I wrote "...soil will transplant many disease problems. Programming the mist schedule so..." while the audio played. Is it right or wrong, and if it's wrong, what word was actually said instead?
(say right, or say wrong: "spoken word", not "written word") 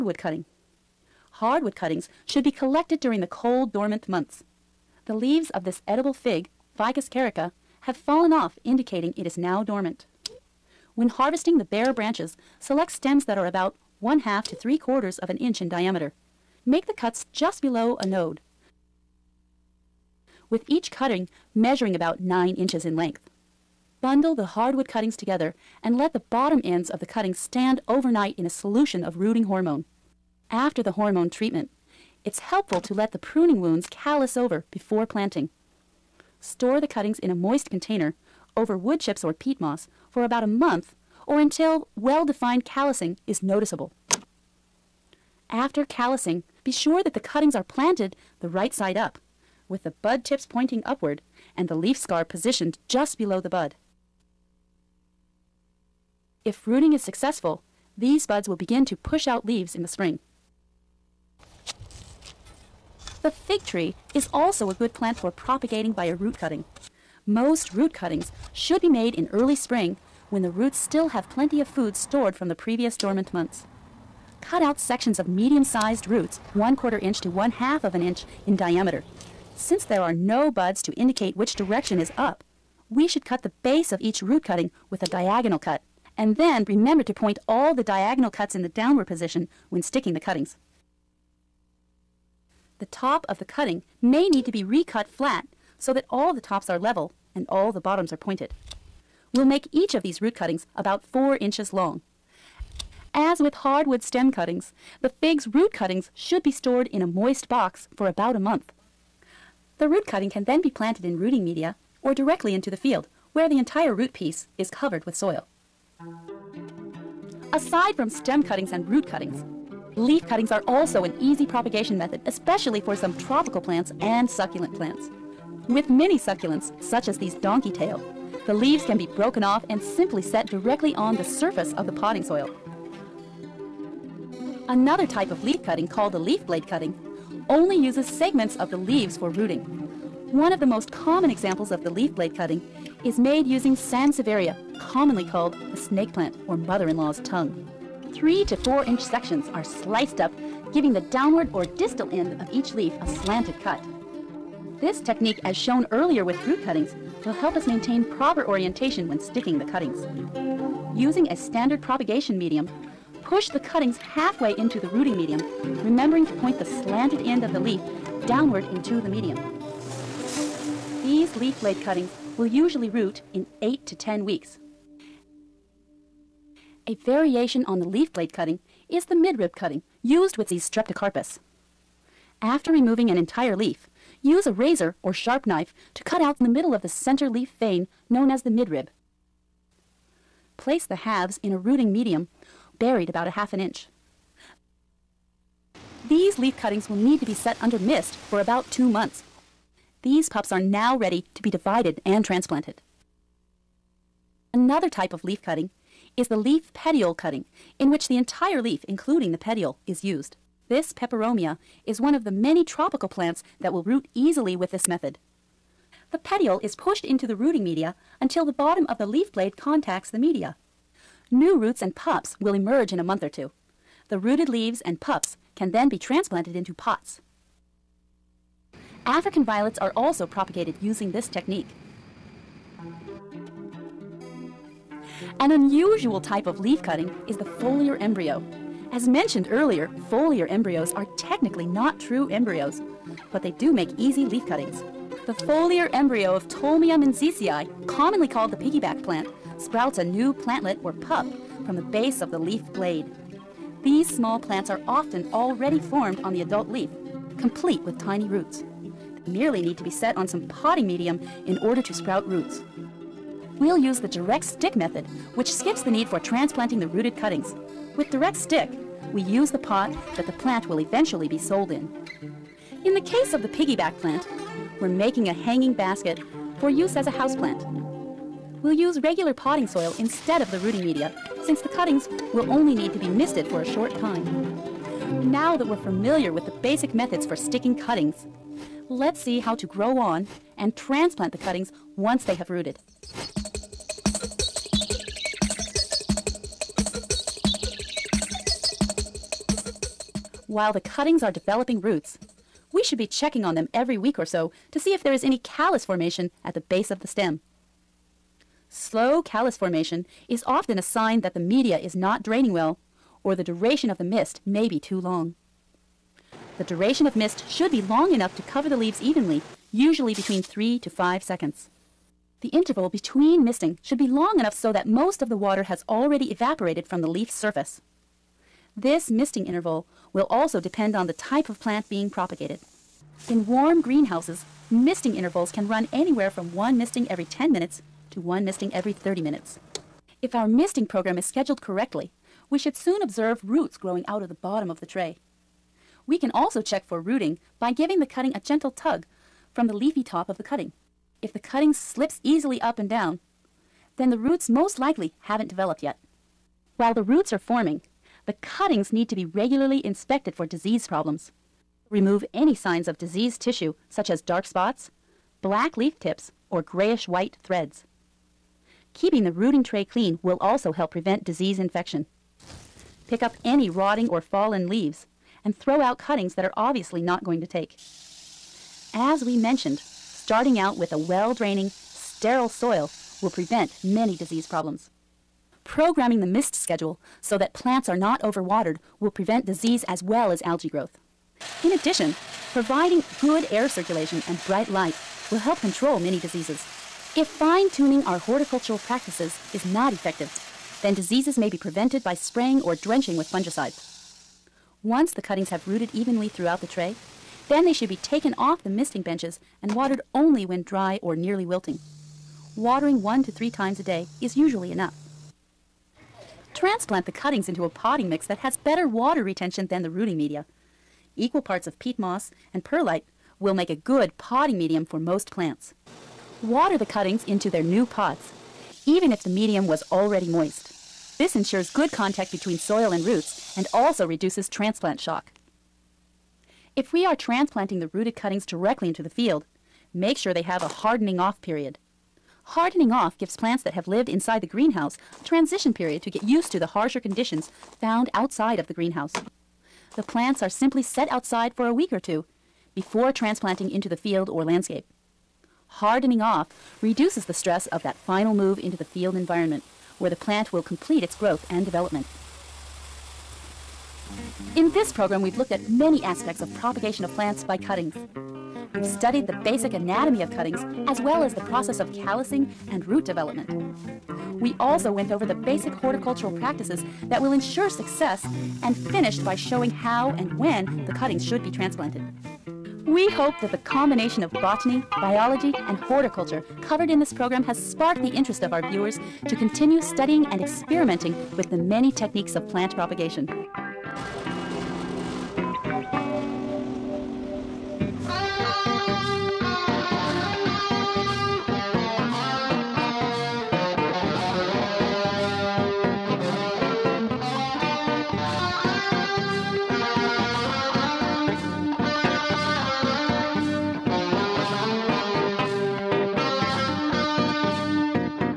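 wrong: "prevent", not "transplant".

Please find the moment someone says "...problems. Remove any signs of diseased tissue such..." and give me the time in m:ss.
6:00.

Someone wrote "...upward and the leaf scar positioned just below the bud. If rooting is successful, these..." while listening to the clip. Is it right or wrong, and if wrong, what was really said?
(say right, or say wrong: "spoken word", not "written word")
right.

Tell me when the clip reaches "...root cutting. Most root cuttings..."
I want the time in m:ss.
1:06.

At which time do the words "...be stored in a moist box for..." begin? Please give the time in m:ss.
1:46.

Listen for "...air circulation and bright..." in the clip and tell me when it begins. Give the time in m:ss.
6:33.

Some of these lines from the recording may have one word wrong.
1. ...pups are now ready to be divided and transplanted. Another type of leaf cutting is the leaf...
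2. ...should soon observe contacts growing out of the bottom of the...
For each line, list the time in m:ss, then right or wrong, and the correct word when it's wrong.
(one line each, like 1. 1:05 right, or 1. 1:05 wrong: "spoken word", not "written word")
1. 3:20 right
2. 5:42 wrong: "roots", not "contacts".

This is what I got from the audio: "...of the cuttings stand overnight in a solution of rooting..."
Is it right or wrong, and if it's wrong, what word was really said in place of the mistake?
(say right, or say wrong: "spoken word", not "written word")
right.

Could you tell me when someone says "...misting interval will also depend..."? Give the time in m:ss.
5:29.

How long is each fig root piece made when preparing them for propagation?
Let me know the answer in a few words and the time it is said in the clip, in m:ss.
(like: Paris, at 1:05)
4 inches, at 1:41.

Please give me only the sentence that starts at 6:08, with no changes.
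Keeping the rooting tray clean will also help prevent disease infection.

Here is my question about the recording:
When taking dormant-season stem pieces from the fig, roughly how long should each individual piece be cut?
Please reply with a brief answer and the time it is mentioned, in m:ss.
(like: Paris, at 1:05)
9 inches, at 0:22.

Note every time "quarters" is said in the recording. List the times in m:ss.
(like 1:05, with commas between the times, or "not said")
0:14, 1:16.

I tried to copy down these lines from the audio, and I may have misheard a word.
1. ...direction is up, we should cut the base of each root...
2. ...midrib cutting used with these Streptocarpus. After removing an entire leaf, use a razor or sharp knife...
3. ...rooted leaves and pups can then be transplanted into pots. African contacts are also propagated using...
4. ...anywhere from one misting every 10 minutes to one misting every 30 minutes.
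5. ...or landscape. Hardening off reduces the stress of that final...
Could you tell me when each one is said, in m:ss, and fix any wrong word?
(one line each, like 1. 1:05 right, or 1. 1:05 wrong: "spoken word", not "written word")
1. 1:21 right
2. 2:59 right
3. 3:44 wrong: "violets", not "contacts"
4. 5:35 right
5. 7:34 right.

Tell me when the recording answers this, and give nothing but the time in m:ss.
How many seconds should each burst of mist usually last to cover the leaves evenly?
5:20.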